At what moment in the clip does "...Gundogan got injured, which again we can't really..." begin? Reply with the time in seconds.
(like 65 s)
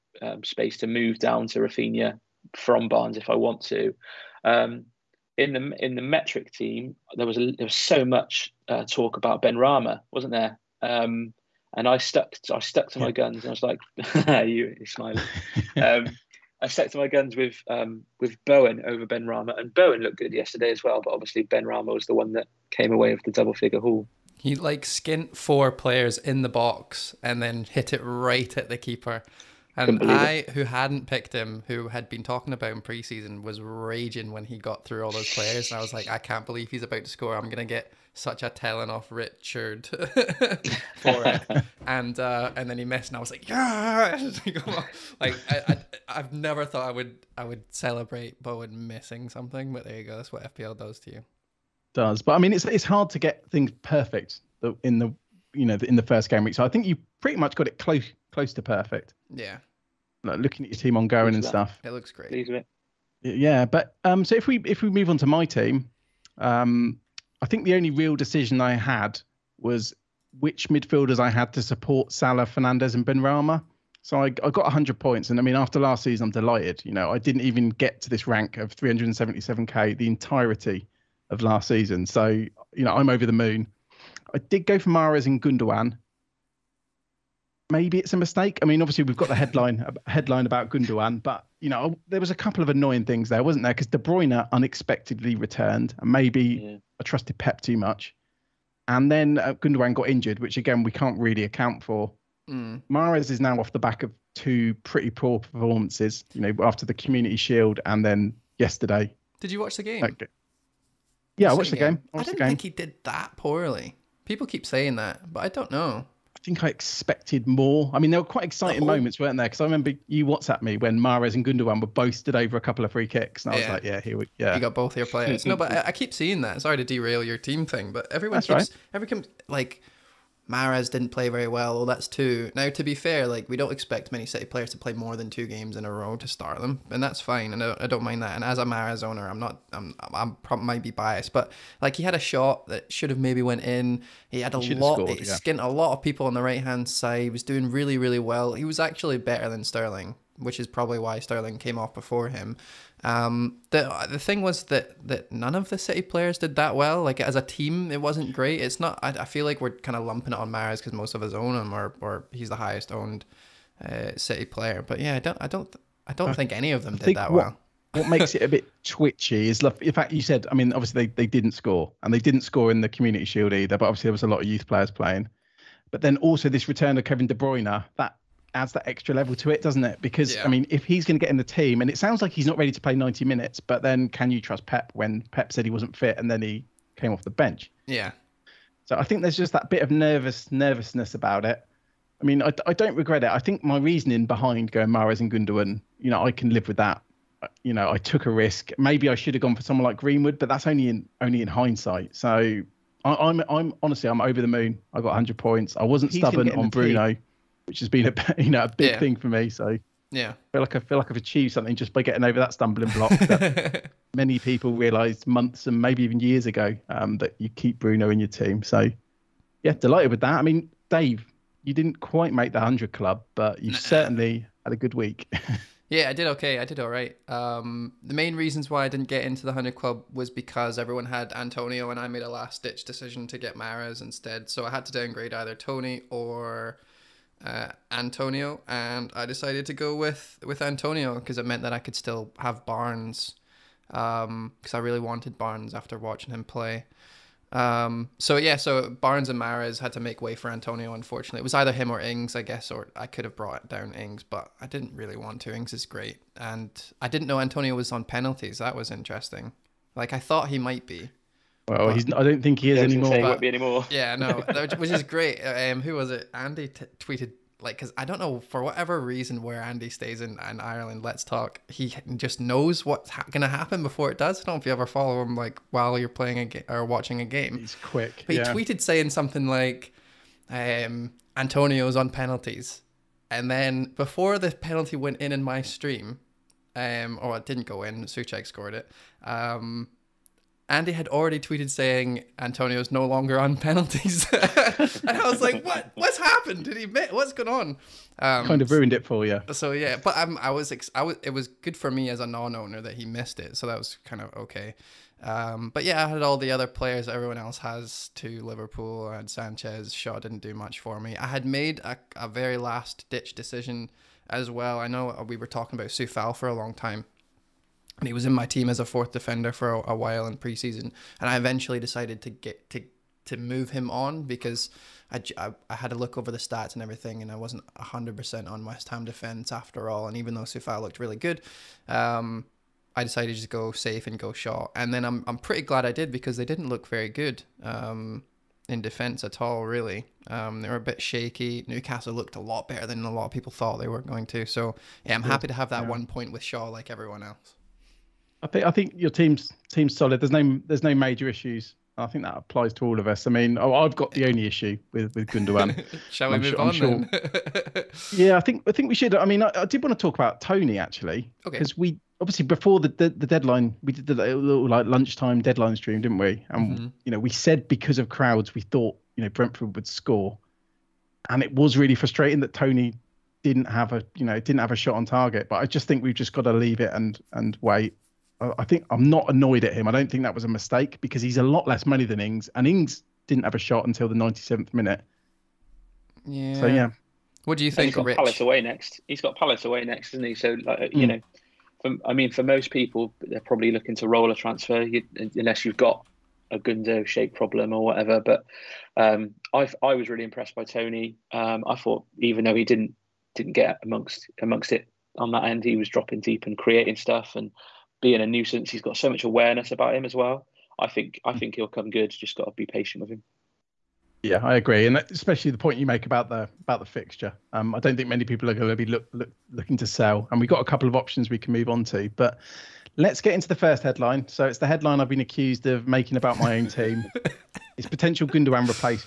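99 s.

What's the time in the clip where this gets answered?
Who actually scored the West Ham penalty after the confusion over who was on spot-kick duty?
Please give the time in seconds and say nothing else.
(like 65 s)
288 s.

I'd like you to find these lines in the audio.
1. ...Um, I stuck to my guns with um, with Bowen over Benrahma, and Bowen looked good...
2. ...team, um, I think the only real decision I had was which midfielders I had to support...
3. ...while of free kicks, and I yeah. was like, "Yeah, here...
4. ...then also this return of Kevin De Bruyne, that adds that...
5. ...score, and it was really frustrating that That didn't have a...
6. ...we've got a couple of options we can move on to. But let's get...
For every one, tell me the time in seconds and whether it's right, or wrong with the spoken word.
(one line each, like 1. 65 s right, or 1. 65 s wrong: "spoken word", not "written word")
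1. 15 s right
2. 65 s right
3. 122 s wrong: "couple", not "while"
4. 176 s right
5. 369 s wrong: "Tony", not "That"
6. 420 s right.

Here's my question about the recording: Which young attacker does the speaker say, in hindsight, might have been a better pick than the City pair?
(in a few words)
Greenwood.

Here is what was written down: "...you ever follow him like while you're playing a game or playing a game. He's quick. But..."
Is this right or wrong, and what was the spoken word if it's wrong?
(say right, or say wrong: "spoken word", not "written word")
wrong: "watching", not "playing".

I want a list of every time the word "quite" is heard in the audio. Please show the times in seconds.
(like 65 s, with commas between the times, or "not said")
118 s, 221 s.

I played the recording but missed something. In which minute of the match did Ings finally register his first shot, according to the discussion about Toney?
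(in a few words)
97th minute.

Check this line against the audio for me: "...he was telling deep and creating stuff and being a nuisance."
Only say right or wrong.
wrong.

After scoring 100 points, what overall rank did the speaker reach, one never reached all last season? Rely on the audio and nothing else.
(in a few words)
377k.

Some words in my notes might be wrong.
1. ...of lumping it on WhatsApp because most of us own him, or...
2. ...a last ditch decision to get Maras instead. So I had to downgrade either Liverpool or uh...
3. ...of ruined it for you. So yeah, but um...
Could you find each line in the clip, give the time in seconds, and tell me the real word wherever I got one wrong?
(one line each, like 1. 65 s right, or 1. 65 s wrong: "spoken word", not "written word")
1. 159 s wrong: "Mahrez", not "WhatsApp"
2. 232 s wrong: "Tony", not "Liverpool"
3. 298 s right.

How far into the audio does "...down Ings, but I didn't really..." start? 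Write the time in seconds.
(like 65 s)
253 s.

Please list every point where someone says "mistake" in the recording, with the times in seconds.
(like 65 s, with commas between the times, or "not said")
88 s, 380 s.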